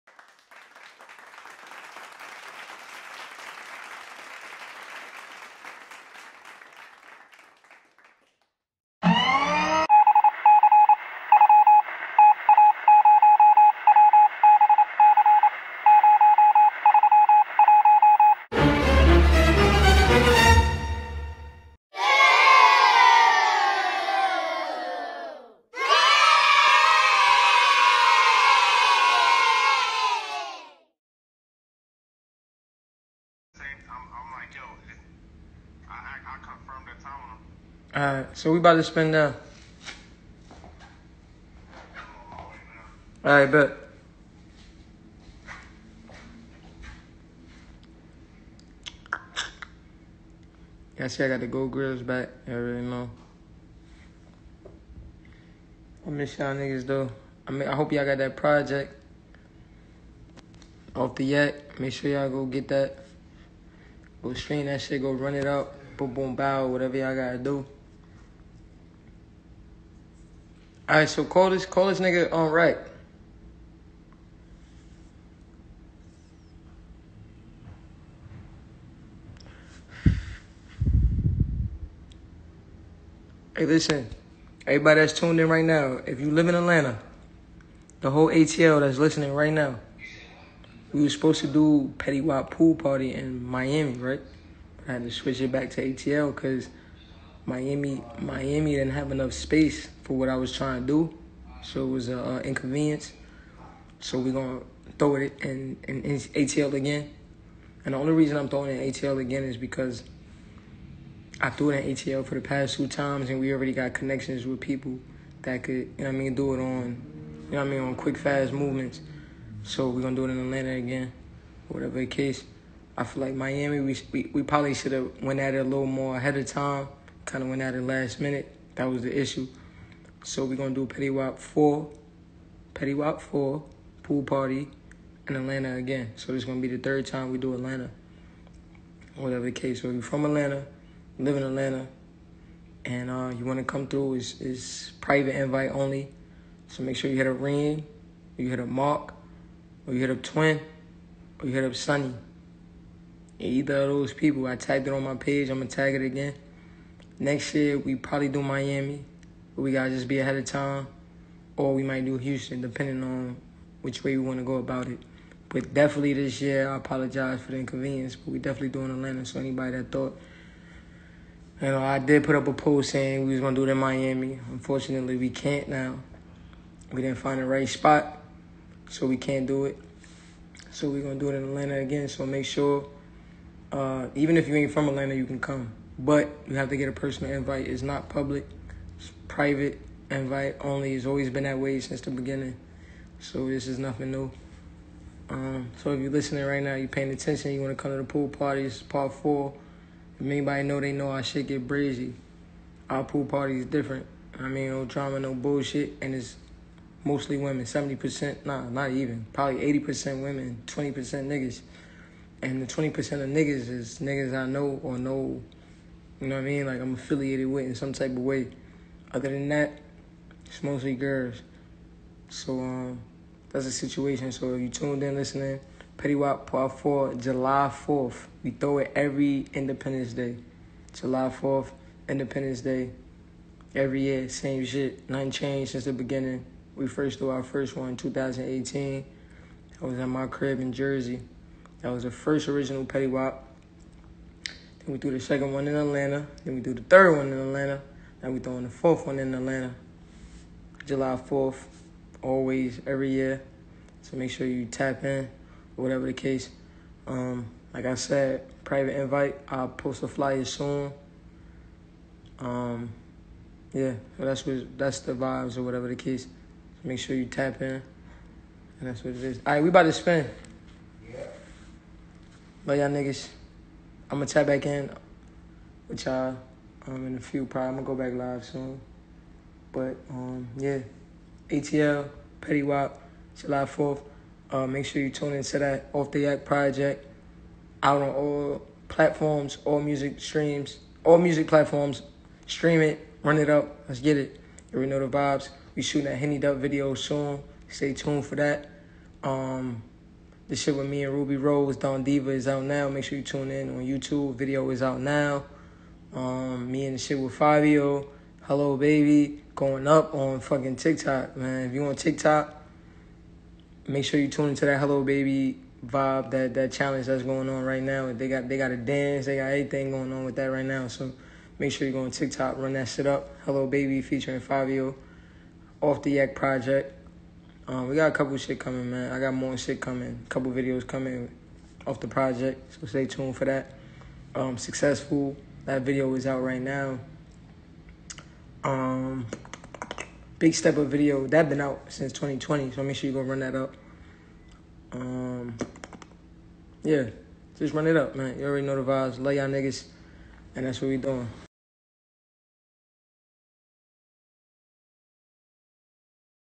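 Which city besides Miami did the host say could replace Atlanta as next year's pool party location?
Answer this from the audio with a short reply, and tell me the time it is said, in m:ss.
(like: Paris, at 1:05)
Houston, at 2:42.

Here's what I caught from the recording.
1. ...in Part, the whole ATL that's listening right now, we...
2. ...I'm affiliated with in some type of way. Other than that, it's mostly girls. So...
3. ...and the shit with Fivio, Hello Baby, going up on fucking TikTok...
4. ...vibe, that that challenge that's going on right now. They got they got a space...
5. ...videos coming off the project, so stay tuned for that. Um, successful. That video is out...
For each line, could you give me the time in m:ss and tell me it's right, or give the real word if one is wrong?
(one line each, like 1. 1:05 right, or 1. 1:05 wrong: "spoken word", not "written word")
1. 1:26 wrong: "Atlanta", not "Part"
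2. 3:36 right
3. 5:06 right
4. 5:15 wrong: "dance", not "space"
5. 5:30 right.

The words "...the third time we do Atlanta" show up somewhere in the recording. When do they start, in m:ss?
2:16.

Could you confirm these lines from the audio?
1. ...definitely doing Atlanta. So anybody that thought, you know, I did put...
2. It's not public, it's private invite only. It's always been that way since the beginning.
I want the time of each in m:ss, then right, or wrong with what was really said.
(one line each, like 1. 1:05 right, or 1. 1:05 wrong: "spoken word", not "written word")
1. 2:48 right
2. 3:07 right.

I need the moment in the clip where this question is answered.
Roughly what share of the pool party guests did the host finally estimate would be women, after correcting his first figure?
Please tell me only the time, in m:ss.
3:29.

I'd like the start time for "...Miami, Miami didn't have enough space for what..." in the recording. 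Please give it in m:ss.
1:37.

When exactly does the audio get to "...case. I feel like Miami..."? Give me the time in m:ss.
2:02.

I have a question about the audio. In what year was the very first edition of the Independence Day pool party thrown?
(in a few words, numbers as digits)
2018.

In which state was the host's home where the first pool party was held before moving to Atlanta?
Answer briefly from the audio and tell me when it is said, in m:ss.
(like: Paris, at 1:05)
Jersey, at 4:00.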